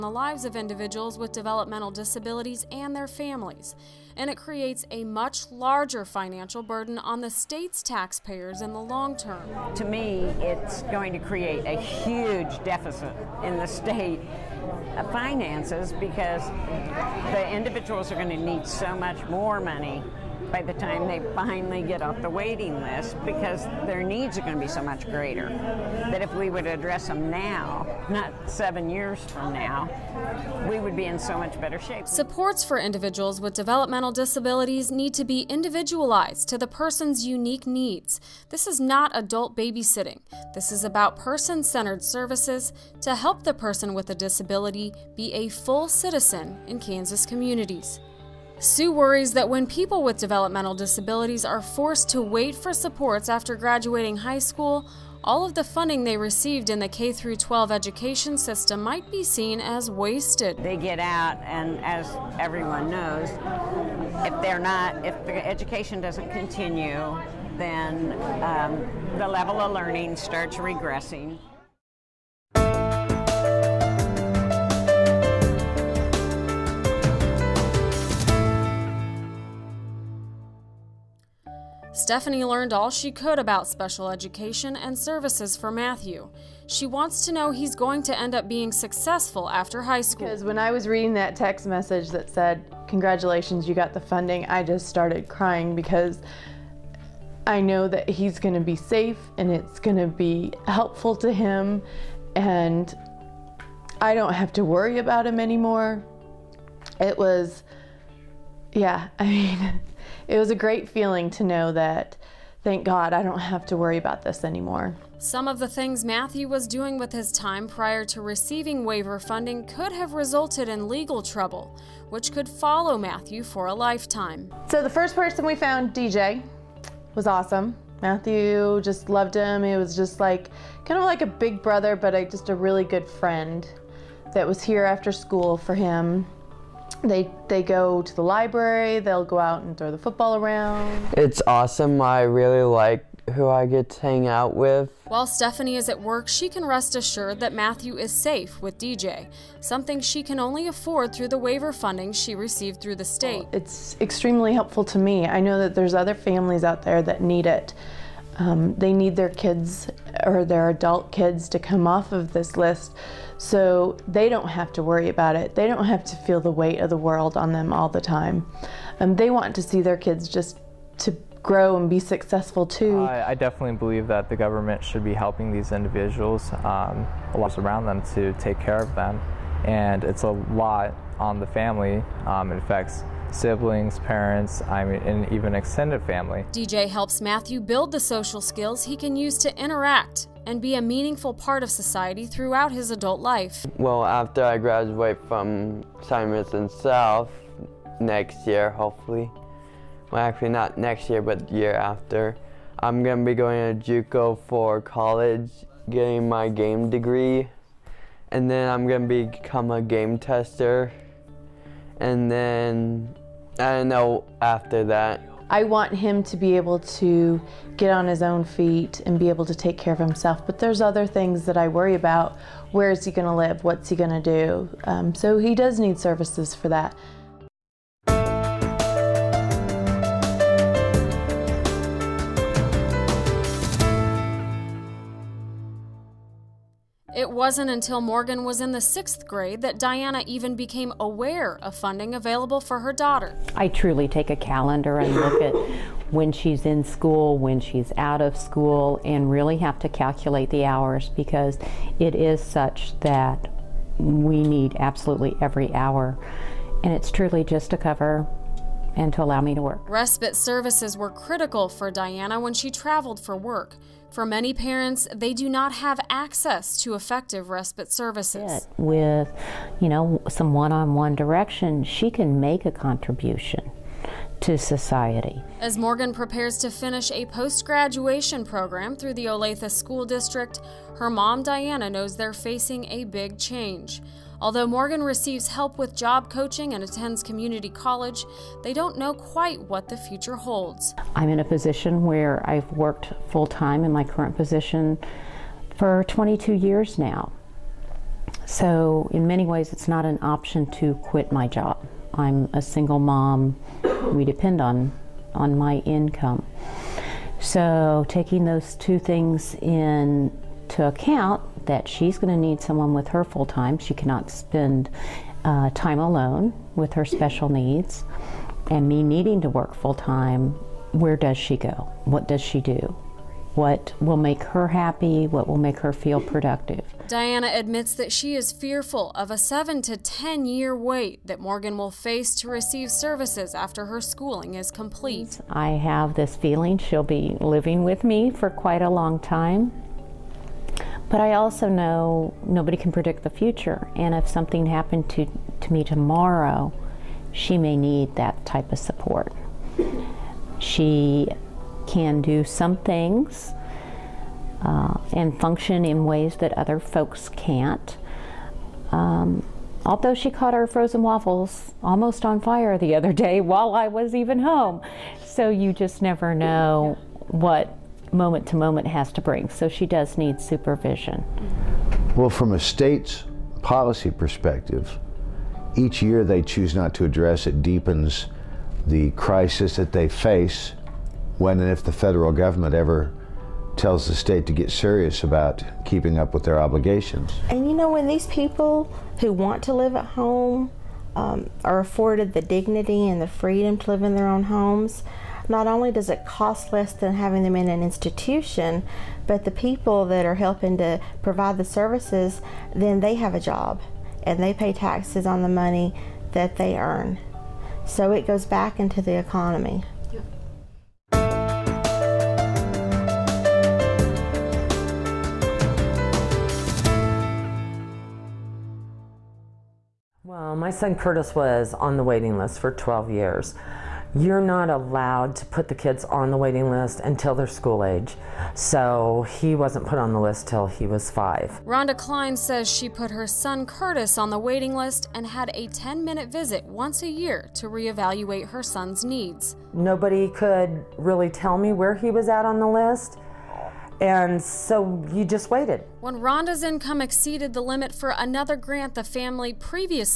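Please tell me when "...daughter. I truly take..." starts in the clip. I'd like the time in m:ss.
4:02.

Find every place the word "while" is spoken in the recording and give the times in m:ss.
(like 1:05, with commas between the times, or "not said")
2:25, 6:03.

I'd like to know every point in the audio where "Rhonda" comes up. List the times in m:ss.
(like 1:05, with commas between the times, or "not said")
7:11, 7:26.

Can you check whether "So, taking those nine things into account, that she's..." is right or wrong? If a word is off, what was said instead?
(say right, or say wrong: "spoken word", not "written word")
wrong: "two", not "nine".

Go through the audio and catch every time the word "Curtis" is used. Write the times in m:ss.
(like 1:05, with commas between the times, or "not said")
7:00, 7:13.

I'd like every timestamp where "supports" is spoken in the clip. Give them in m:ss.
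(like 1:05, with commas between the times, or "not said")
0:32, 0:52, 5:48.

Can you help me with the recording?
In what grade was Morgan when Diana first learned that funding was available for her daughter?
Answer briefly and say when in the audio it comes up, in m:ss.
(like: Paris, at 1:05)
sixth grade, at 3:58.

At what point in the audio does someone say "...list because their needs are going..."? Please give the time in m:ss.
0:22.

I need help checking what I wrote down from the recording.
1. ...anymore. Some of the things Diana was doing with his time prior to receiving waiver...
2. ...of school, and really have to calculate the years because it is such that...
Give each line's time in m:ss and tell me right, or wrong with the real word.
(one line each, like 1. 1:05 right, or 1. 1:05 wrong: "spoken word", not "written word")
1. 1:54 wrong: "Matthew", not "Diana"
2. 4:08 wrong: "hours", not "years".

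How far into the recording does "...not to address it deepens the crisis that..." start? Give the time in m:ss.
6:16.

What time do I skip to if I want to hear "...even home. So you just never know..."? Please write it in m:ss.
6:04.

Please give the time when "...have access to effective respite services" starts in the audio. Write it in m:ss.
4:25.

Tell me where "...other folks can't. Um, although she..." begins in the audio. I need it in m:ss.
5:56.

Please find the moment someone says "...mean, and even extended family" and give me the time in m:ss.
3:04.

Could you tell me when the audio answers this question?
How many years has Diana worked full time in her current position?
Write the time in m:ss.
4:56.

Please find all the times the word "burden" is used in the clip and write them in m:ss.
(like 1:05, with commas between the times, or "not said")
0:06.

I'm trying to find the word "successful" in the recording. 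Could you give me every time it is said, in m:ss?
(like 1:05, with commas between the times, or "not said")
1:28, 2:51.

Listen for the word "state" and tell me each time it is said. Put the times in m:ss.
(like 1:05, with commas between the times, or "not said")
0:07, 0:13, 2:33, 6:12, 6:24.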